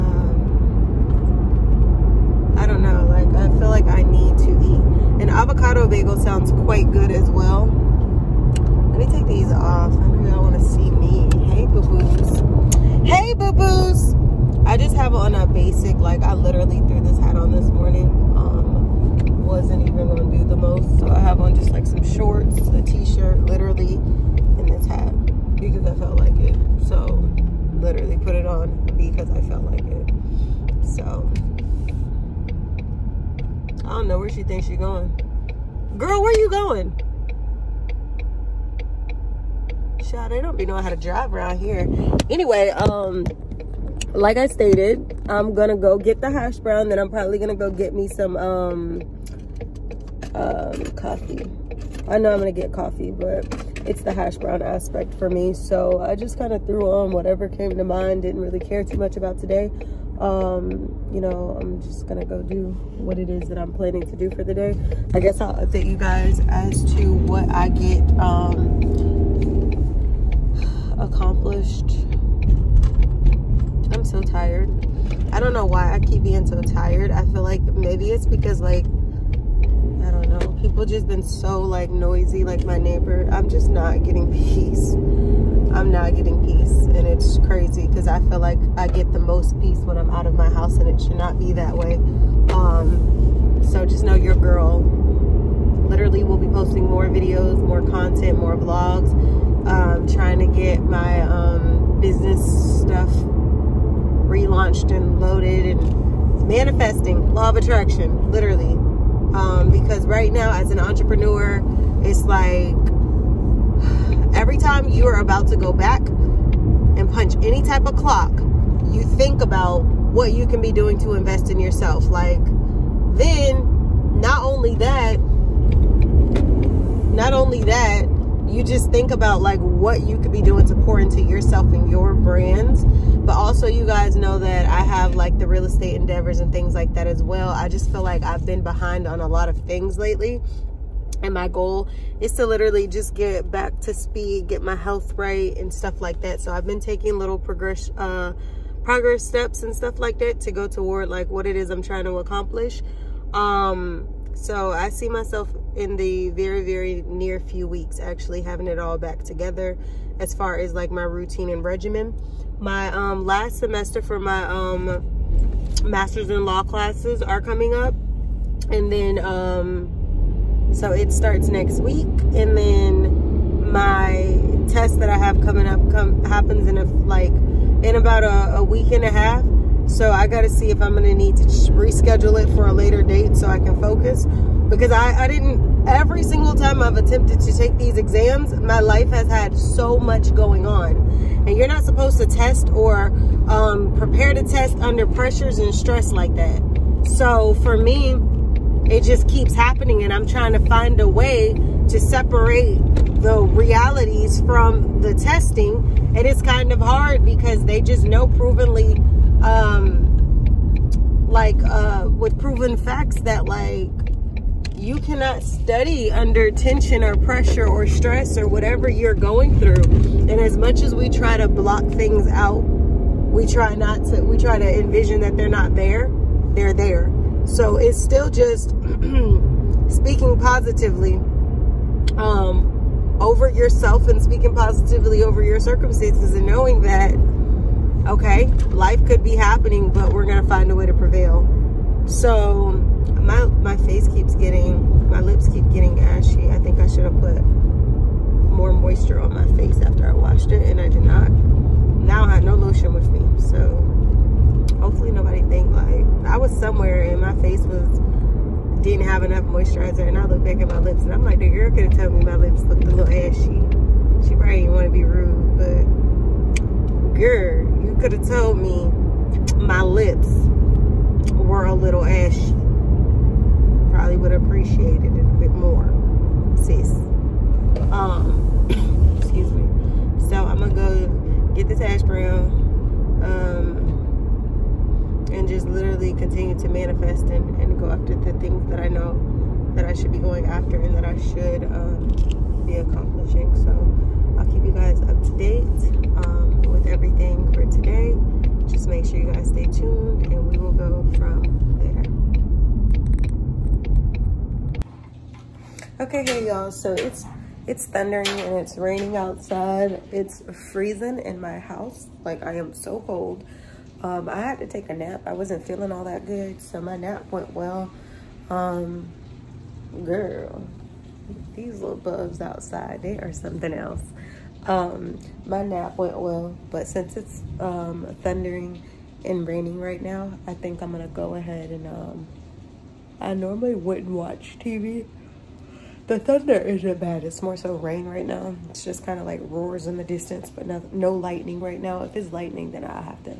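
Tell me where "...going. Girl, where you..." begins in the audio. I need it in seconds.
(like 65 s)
34 s.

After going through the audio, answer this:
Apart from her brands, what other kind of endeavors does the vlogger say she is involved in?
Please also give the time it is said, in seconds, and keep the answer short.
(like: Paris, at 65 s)
real estate, at 135 s.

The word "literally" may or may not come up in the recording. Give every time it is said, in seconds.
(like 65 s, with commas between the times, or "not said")
16 s, 23 s, 27 s, 95 s, 108 s, 142 s.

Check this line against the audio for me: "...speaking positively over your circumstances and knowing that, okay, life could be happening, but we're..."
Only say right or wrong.
right.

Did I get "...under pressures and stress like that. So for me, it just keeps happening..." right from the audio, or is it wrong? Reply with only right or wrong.
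right.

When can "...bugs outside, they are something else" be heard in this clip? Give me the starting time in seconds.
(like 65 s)
321 s.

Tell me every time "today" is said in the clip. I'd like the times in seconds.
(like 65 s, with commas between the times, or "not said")
59 s, 297 s.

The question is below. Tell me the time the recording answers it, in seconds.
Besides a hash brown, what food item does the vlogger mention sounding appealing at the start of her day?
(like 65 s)
5 s.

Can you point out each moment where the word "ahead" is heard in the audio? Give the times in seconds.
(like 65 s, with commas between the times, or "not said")
331 s.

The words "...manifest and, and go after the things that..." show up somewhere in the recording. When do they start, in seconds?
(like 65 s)
286 s.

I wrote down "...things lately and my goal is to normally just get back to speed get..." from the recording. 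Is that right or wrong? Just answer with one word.
wrong.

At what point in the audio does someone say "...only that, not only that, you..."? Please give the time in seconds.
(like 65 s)
124 s.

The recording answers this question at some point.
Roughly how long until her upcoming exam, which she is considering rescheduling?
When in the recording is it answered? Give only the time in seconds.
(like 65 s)
178 s.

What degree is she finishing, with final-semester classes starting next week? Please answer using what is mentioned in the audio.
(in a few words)
master's in law.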